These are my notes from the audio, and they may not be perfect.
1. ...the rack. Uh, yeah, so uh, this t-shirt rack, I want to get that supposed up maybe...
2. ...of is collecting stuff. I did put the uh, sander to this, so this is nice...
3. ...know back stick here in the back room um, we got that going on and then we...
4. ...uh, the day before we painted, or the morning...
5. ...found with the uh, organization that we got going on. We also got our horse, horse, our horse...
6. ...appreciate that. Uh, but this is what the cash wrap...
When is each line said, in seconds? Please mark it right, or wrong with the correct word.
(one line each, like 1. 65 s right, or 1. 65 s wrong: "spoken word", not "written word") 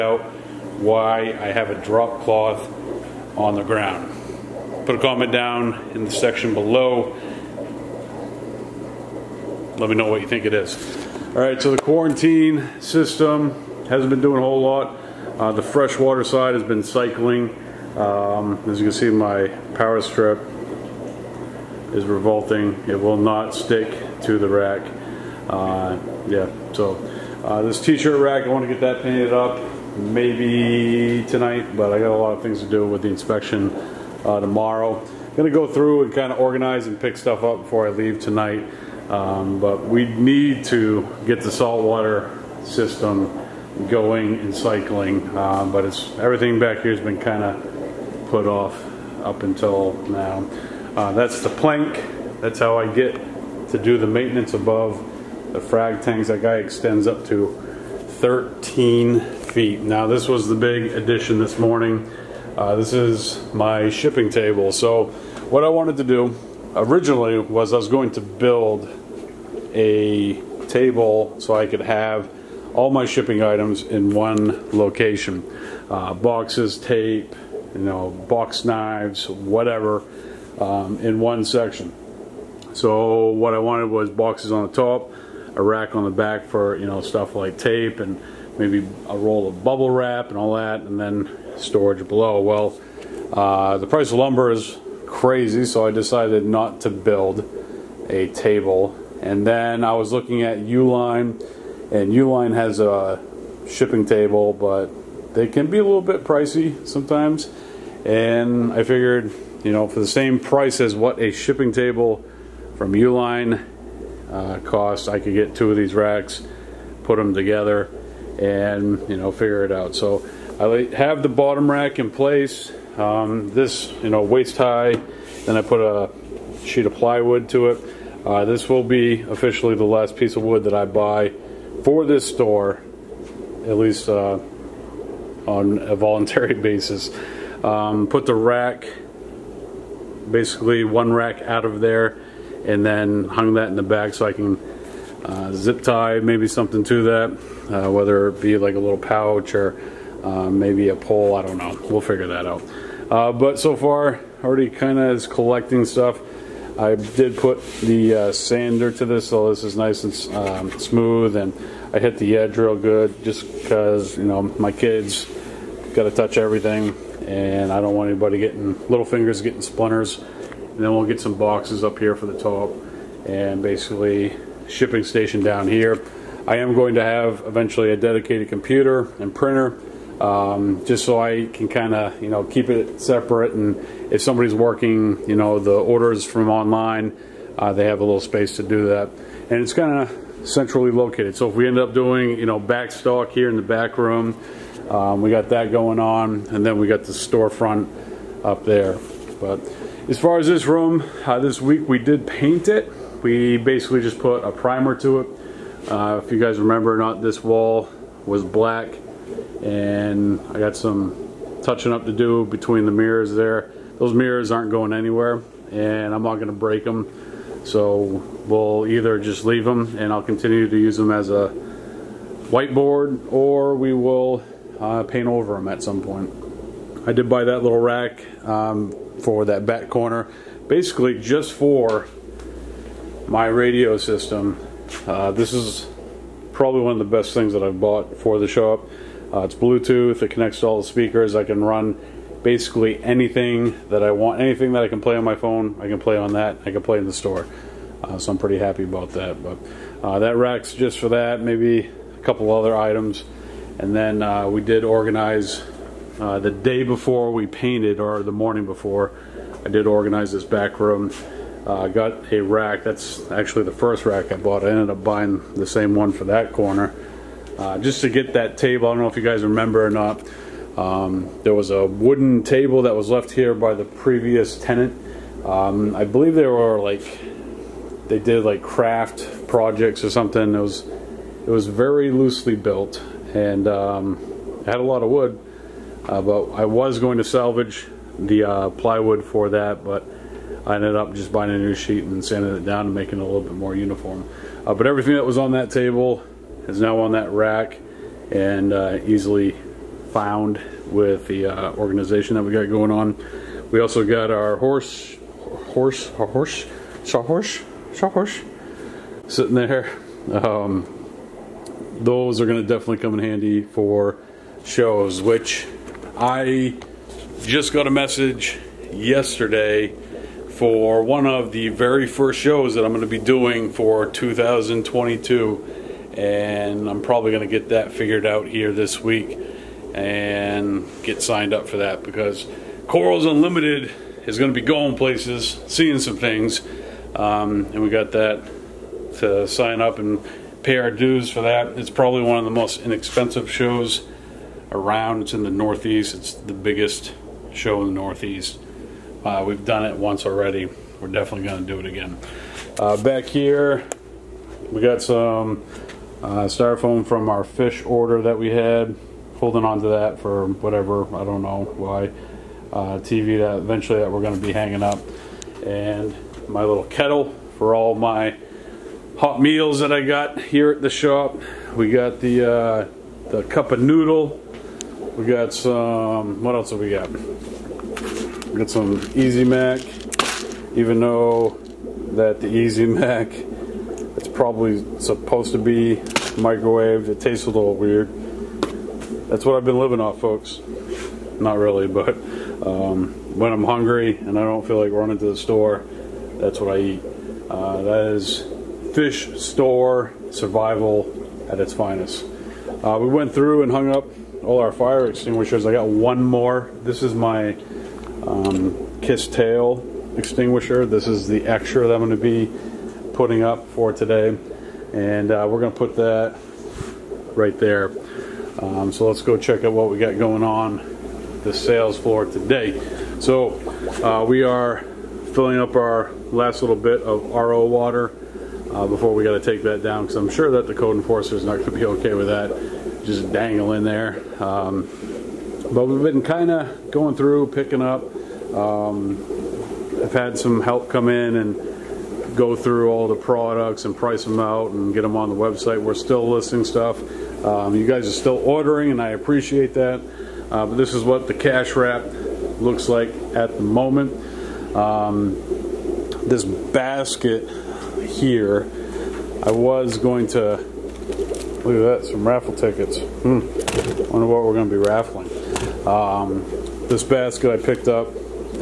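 1. 24 s wrong: "painted", not "supposed"
2. 154 s right
3. 192 s wrong: "stock", not "stick"
4. 256 s right
5. 300 s right
6. 449 s right.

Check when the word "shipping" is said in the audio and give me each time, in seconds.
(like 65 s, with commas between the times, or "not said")
63 s, 73 s, 103 s, 111 s, 174 s.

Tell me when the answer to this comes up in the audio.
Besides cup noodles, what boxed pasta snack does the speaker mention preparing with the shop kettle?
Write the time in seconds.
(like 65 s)
379 s.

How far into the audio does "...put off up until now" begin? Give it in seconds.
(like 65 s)
48 s.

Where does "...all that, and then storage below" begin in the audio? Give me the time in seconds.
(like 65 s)
90 s.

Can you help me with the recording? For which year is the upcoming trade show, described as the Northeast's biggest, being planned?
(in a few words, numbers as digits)
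2022.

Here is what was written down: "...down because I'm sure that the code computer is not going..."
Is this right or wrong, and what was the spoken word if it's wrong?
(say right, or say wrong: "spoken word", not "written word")
wrong: "enforcer", not "computer".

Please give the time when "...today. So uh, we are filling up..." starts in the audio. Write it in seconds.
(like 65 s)
422 s.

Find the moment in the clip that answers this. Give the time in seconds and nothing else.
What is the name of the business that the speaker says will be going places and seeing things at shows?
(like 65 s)
332 s.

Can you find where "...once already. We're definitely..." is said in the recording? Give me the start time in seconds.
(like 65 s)
349 s.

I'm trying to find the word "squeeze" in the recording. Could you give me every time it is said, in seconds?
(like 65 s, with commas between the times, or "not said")
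not said.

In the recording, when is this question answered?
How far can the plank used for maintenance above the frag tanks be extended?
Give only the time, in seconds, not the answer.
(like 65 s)
58 s.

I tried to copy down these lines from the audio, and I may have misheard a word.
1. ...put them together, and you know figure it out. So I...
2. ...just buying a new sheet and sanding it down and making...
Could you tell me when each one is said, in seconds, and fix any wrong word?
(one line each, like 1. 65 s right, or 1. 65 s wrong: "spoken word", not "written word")
1. 117 s right
2. 291 s right.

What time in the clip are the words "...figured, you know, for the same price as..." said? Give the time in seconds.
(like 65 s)
108 s.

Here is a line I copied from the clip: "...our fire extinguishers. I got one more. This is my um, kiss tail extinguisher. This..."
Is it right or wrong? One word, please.
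right.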